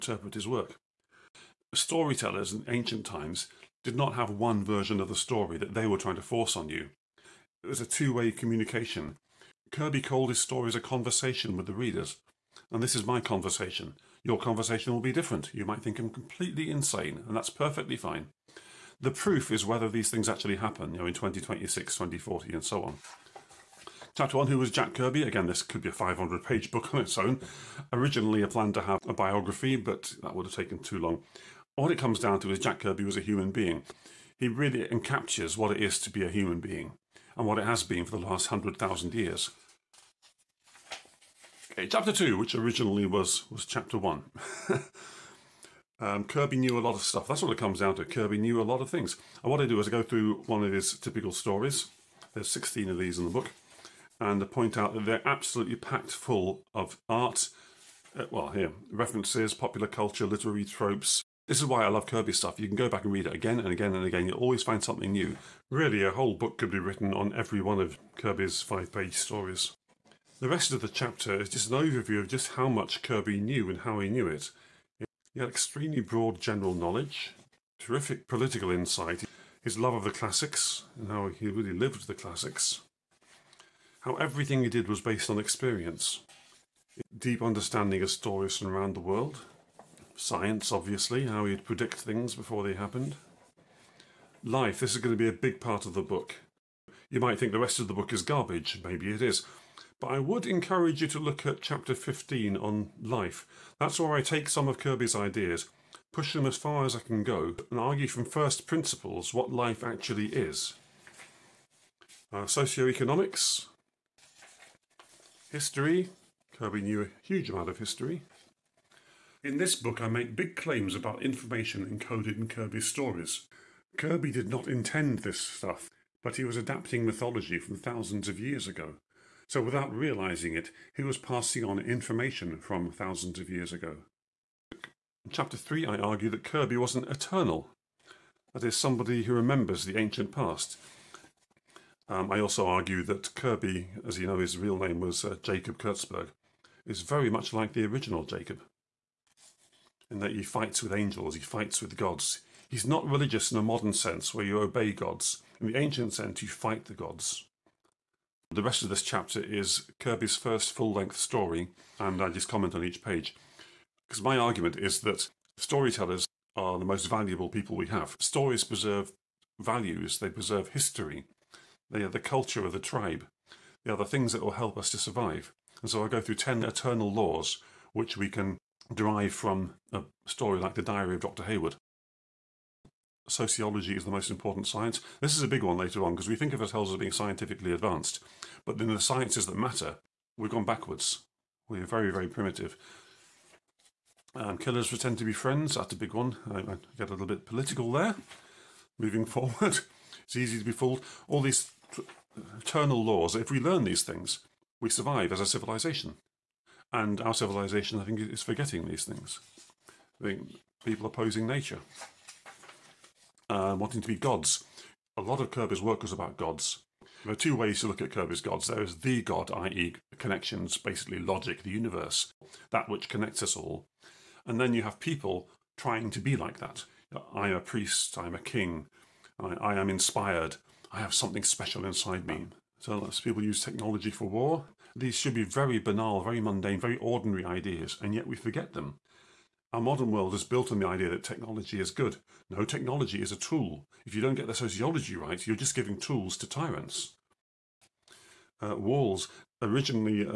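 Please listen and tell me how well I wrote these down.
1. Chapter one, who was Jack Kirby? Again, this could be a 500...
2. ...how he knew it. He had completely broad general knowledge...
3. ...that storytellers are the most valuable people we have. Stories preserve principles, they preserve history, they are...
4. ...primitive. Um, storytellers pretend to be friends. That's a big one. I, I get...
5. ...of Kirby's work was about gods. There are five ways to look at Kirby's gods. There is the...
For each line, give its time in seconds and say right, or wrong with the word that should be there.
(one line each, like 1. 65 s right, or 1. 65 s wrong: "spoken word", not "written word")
1. 24 s right
2. 73 s wrong: "extremely", not "completely"
3. 164 s wrong: "values", not "principles"
4. 192 s wrong: "killers", not "storytellers"
5. 215 s wrong: "two", not "five".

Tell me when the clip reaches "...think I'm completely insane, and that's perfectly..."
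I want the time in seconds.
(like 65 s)
15 s.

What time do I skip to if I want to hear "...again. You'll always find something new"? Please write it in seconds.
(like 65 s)
64 s.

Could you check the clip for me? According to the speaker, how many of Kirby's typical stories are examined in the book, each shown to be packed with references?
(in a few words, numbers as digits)
16.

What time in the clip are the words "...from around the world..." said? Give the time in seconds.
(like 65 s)
88 s.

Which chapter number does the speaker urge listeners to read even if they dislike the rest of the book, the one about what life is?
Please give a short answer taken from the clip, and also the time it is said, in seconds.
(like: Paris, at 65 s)
15, at 101 s.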